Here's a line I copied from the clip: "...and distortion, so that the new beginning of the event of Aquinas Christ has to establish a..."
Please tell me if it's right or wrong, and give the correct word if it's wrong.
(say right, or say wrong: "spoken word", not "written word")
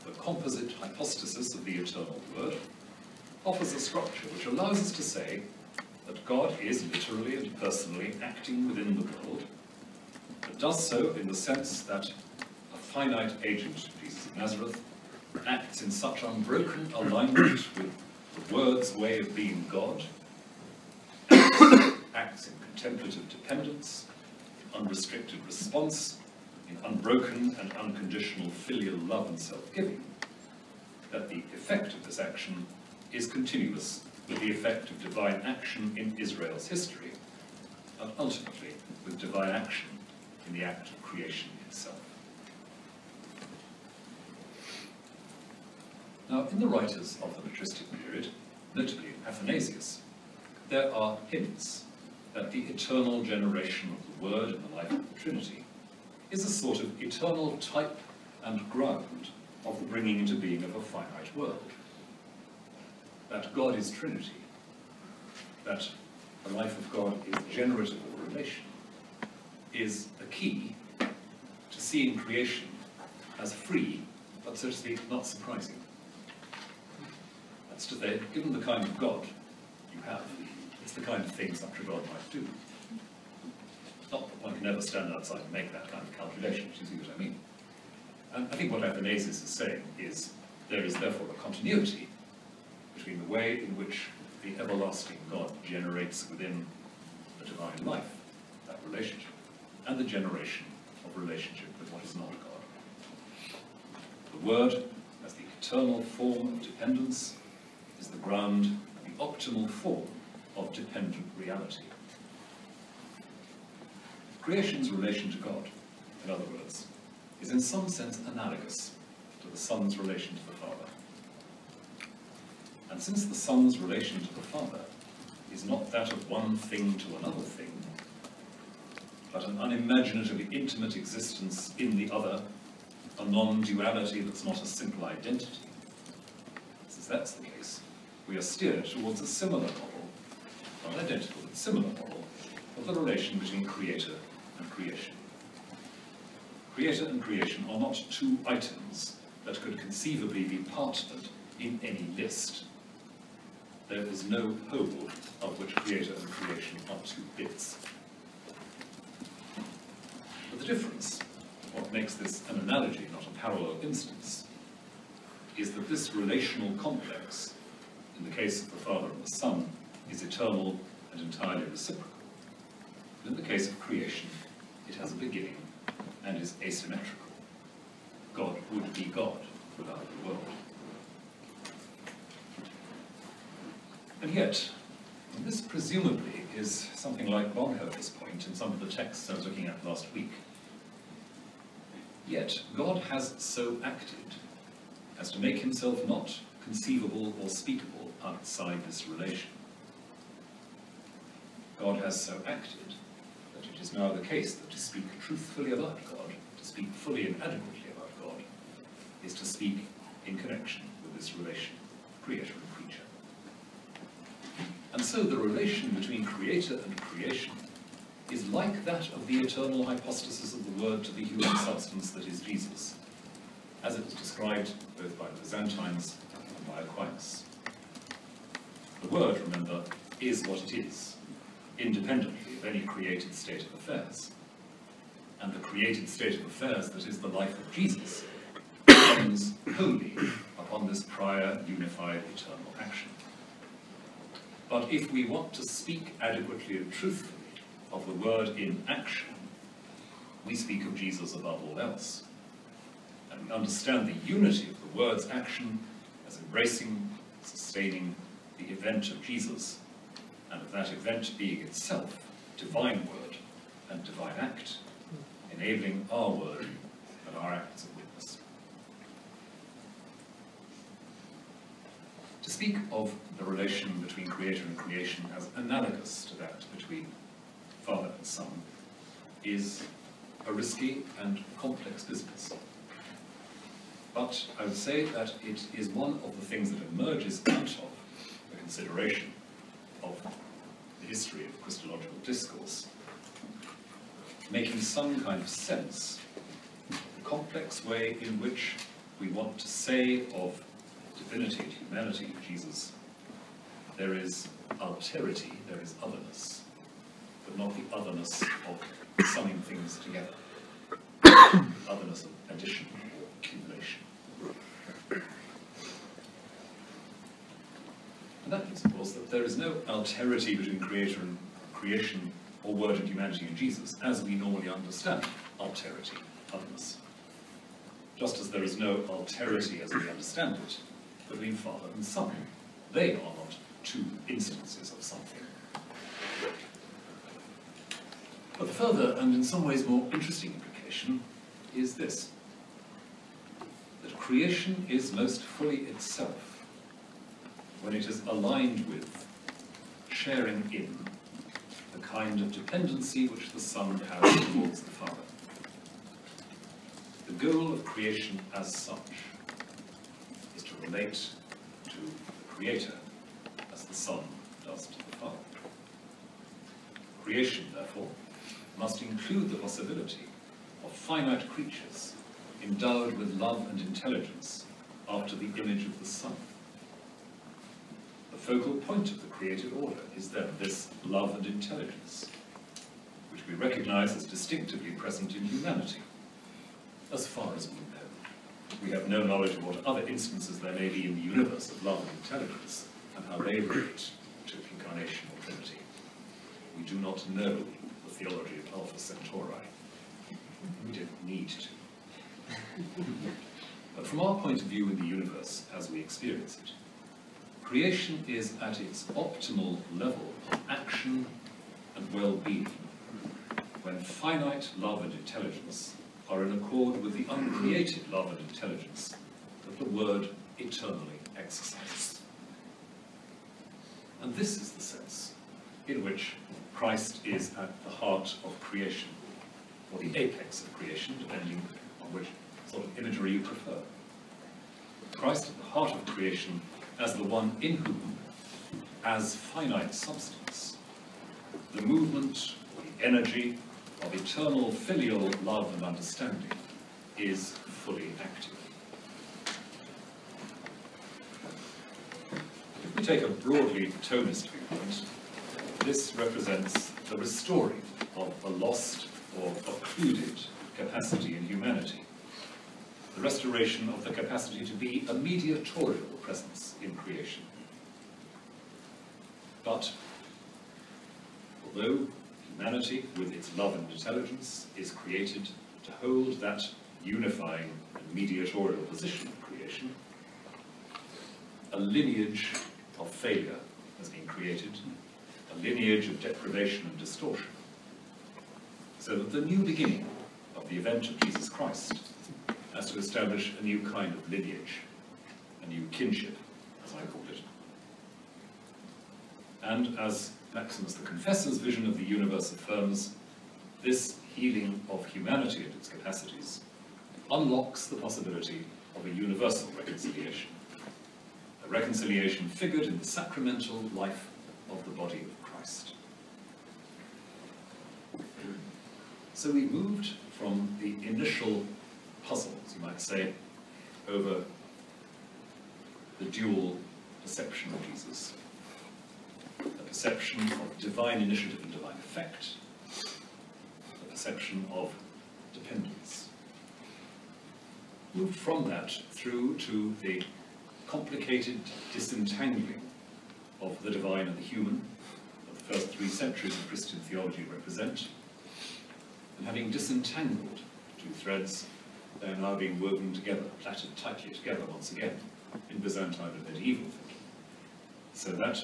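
wrong: "Jesus", not "Aquinas".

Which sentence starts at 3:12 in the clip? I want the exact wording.
Yet, God has so acted as to make himself not conceivable or speakable outside this relation.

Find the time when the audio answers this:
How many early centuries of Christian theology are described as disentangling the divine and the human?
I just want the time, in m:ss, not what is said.
9:05.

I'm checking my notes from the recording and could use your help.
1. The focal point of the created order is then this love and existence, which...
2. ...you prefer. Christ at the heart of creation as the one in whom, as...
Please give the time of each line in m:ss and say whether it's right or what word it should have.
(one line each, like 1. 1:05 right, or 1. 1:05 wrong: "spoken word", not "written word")
1. 6:18 wrong: "intelligence", not "existence"
2. 7:13 right.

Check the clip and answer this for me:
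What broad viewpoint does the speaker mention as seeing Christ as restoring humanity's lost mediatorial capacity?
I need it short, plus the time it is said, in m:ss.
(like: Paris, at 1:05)
Thomist, at 7:34.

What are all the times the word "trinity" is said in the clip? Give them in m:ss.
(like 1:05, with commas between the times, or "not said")
0:55, 1:03, 6:35.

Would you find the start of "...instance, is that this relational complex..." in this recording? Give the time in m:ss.
2:43.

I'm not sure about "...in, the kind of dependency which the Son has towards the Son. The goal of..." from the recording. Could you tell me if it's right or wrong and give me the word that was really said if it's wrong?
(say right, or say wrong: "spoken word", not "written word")
wrong: "Father", not "Son".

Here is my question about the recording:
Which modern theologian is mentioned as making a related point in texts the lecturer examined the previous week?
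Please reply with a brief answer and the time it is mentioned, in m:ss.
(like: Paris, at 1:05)
Bonhoeffer, at 3:07.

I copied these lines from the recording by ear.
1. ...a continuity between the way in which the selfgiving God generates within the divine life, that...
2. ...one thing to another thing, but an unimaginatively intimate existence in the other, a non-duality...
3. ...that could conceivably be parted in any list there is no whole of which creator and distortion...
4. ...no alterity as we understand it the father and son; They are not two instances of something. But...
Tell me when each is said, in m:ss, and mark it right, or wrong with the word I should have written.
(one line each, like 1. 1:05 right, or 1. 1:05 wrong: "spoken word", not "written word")
1. 1:31 wrong: "everlasting", not "selfgiving"
2. 2:06 right
3. 2:29 wrong: "creation", not "distortion"
4. 5:28 right.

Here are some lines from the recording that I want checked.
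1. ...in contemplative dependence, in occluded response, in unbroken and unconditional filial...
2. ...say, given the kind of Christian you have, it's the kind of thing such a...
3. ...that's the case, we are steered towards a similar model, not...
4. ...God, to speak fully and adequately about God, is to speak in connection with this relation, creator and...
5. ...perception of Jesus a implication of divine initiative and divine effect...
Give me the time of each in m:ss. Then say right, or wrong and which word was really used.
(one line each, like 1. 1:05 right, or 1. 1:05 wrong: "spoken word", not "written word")
1. 0:22 wrong: "unrestricted", not "occluded"
2. 1:17 wrong: "God", not "Christian"
3. 2:17 right
4. 3:26 right
5. 8:47 wrong: "perception", not "implication".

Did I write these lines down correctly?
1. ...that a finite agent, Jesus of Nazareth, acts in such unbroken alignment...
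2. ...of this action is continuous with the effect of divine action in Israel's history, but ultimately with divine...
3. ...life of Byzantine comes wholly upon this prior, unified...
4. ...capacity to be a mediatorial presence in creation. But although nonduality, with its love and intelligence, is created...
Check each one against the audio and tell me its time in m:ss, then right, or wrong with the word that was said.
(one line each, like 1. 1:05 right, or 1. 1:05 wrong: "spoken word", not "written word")
1. 0:11 right
2. 0:31 right
3. 3:57 wrong: "Jesus", not "Byzantine"
4. 7:44 wrong: "humanity", not "nonduality".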